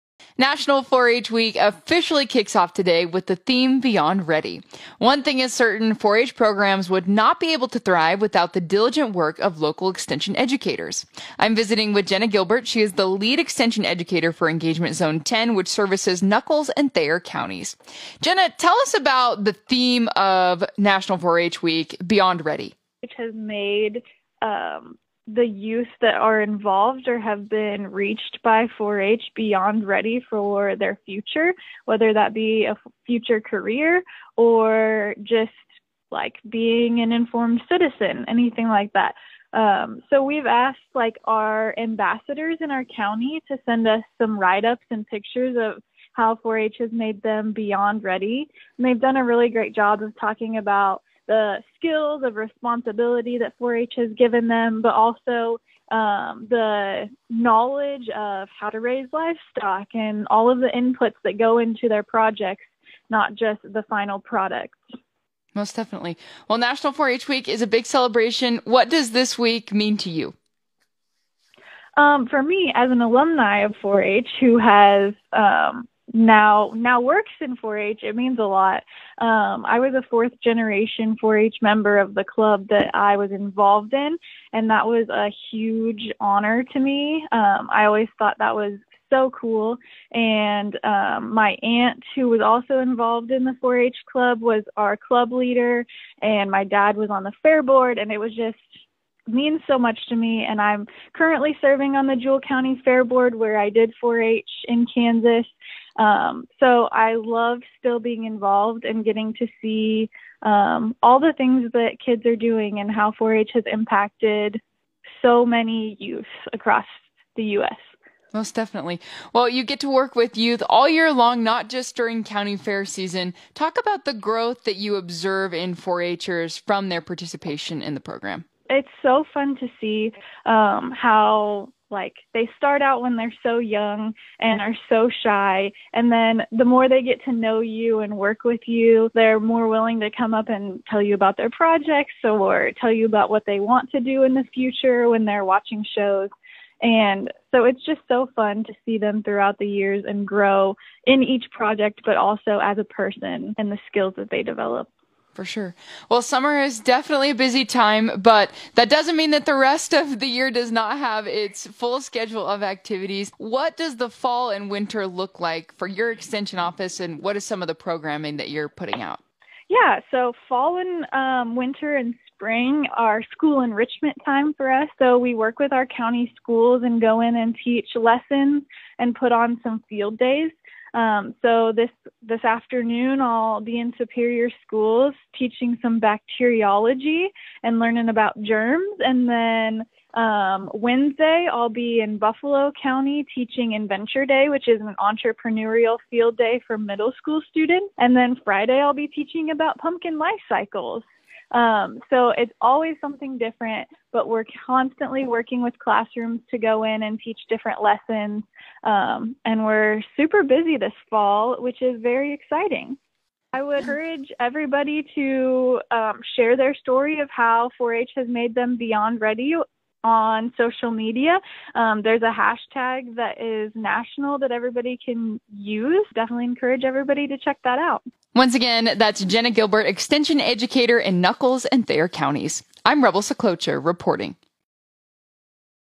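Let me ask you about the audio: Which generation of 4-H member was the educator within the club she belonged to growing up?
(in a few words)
Fourth generation.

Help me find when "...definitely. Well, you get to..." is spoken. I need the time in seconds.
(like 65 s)
118 s.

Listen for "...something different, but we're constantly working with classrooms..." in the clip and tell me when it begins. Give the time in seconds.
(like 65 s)
203 s.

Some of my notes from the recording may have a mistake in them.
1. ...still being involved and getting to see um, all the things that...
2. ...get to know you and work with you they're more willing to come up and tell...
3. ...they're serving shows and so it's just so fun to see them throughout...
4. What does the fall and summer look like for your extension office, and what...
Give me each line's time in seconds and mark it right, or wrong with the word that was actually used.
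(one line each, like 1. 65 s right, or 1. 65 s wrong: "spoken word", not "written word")
1. 107 s right
2. 137 s right
3. 145 s wrong: "watching", not "serving"
4. 163 s wrong: "winter", not "summer".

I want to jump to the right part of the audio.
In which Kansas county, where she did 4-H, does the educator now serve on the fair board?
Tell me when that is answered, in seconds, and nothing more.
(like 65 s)
102 s.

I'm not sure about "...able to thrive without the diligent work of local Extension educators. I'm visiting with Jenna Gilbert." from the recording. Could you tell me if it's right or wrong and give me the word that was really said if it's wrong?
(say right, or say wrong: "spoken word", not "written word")
right.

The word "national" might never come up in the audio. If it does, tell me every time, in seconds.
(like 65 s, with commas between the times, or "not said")
0 s, 20 s, 66 s, 223 s.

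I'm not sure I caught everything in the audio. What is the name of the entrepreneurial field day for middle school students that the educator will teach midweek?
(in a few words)
Adventure Day.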